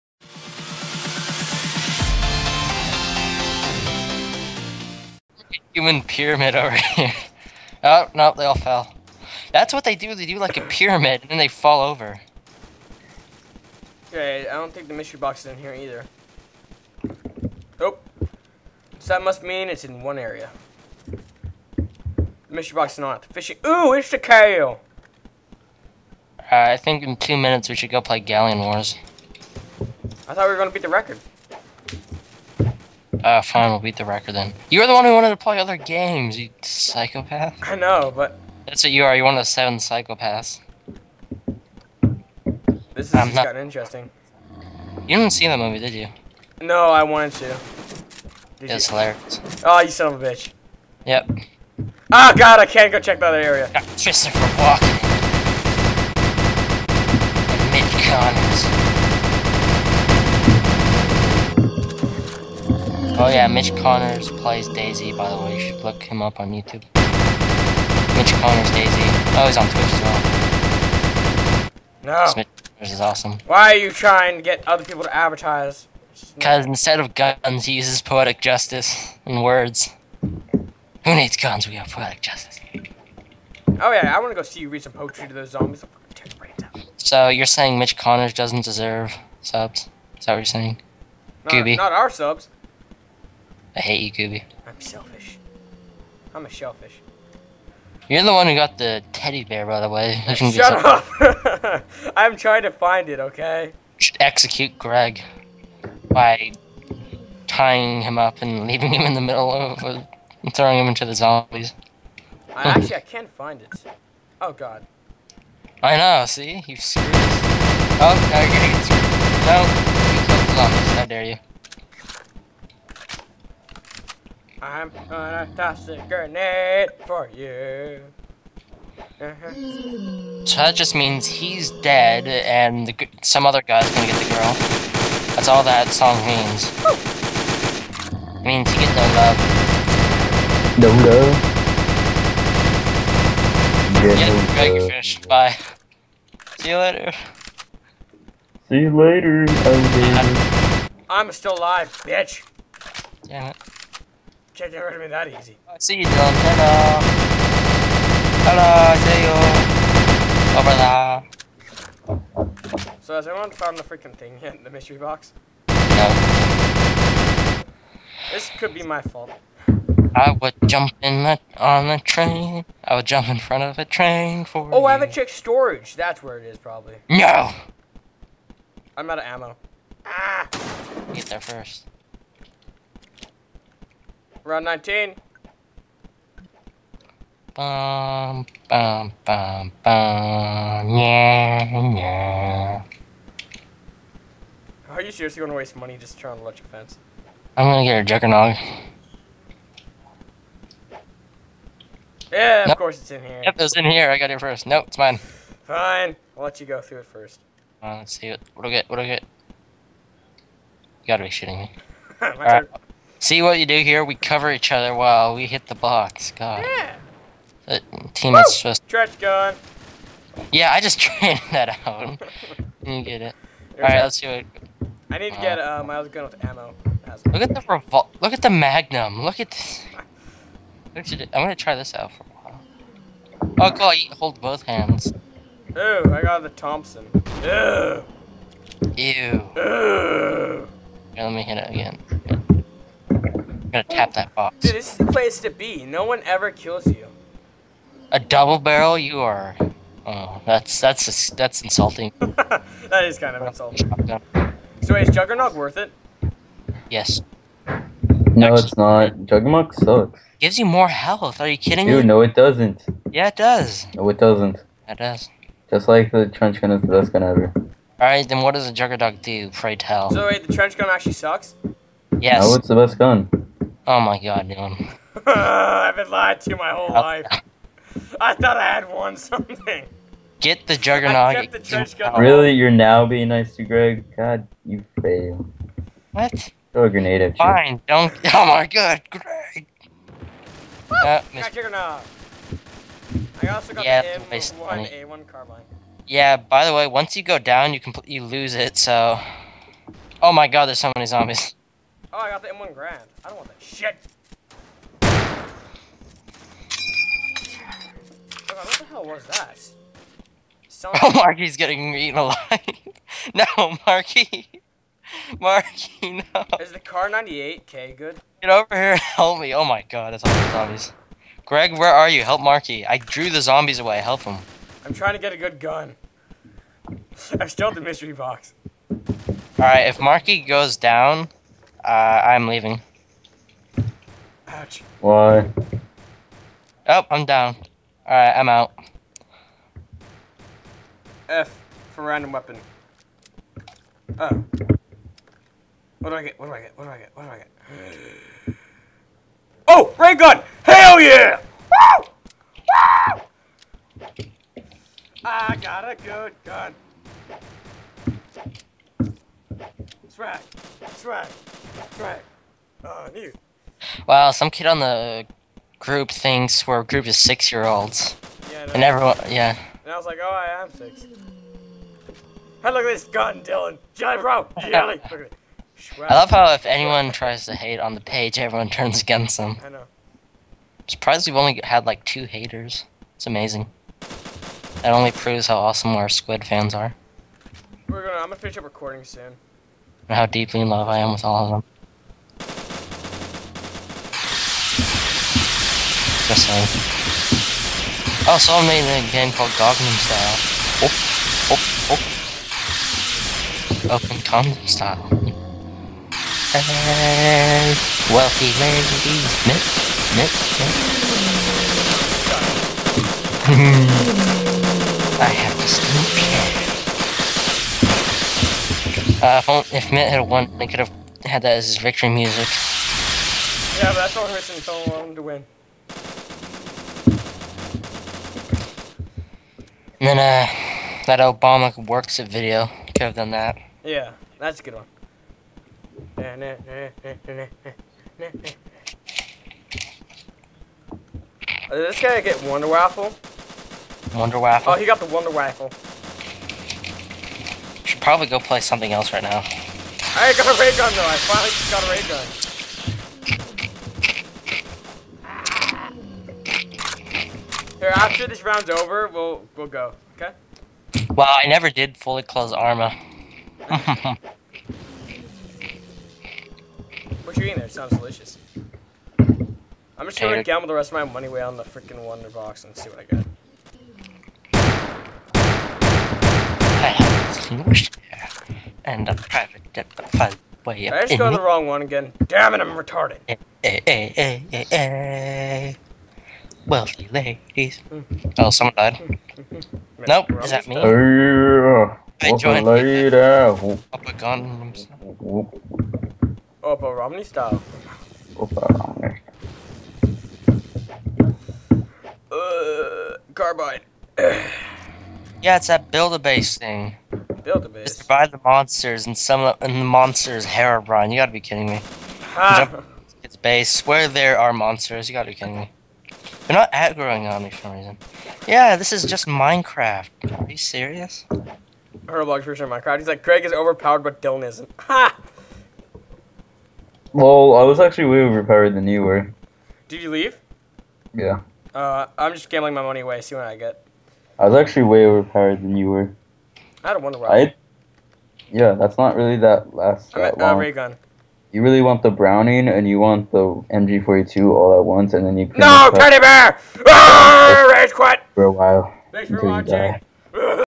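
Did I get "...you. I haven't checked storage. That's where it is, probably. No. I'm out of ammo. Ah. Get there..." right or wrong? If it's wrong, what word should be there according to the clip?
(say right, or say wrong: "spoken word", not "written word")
right.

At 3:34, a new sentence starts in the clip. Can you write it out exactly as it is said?
We cover each other while we hit the box.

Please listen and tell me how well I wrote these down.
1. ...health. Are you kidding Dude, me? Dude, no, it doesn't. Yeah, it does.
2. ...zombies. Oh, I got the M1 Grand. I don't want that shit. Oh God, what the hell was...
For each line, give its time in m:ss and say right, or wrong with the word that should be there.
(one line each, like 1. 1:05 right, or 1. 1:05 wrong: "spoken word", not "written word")
1. 4:20 right
2. 5:01 right.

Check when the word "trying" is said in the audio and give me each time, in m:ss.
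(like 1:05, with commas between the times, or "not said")
1:13, 1:42, 3:16, 5:24.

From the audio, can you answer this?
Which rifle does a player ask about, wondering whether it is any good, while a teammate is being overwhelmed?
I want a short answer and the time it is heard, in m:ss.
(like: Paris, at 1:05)
Kar98K, at 5:16.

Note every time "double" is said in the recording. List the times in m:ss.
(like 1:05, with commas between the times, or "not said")
4:08.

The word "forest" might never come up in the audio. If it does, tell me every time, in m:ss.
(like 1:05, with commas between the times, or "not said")
not said.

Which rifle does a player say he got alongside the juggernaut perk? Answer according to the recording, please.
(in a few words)
M1A1 carbine.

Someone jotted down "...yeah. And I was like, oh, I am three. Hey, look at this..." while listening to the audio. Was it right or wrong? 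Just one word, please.
wrong.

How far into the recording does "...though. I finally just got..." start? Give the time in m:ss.
7:30.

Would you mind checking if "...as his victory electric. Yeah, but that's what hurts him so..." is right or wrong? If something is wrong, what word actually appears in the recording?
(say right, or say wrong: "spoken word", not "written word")
wrong: "music", not "electric".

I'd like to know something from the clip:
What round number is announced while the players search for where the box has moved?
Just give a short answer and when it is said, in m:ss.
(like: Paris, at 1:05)
19, at 3:04.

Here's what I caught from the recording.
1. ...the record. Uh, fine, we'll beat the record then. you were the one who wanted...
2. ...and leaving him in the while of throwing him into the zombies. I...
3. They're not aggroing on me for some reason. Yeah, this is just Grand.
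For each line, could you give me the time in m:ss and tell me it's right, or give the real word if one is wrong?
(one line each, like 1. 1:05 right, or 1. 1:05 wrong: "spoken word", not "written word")
1. 0:30 right
2. 1:48 wrong: "middle", not "while"
3. 8:36 wrong: "Minecraft", not "Grand".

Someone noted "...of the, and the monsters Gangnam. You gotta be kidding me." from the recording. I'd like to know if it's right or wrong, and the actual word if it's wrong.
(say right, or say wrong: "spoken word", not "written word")
wrong: "Brian", not "Gangnam".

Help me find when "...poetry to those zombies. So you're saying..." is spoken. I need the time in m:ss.
1:24.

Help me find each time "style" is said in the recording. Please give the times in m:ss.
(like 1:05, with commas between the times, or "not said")
6:40, 6:44, 8:17.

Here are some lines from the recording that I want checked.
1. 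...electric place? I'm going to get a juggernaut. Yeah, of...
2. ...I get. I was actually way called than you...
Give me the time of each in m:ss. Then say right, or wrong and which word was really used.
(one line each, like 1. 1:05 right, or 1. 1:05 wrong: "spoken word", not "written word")
1. 3:16 wrong: "fence", not "place"
2. 8:53 wrong: "overpowered", not "called".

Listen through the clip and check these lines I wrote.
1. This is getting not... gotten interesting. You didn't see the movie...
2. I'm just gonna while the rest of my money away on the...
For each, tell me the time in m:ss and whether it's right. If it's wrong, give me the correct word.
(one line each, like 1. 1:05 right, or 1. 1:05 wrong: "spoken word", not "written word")
1. 0:42 right
2. 7:49 wrong: "gamble", not "while".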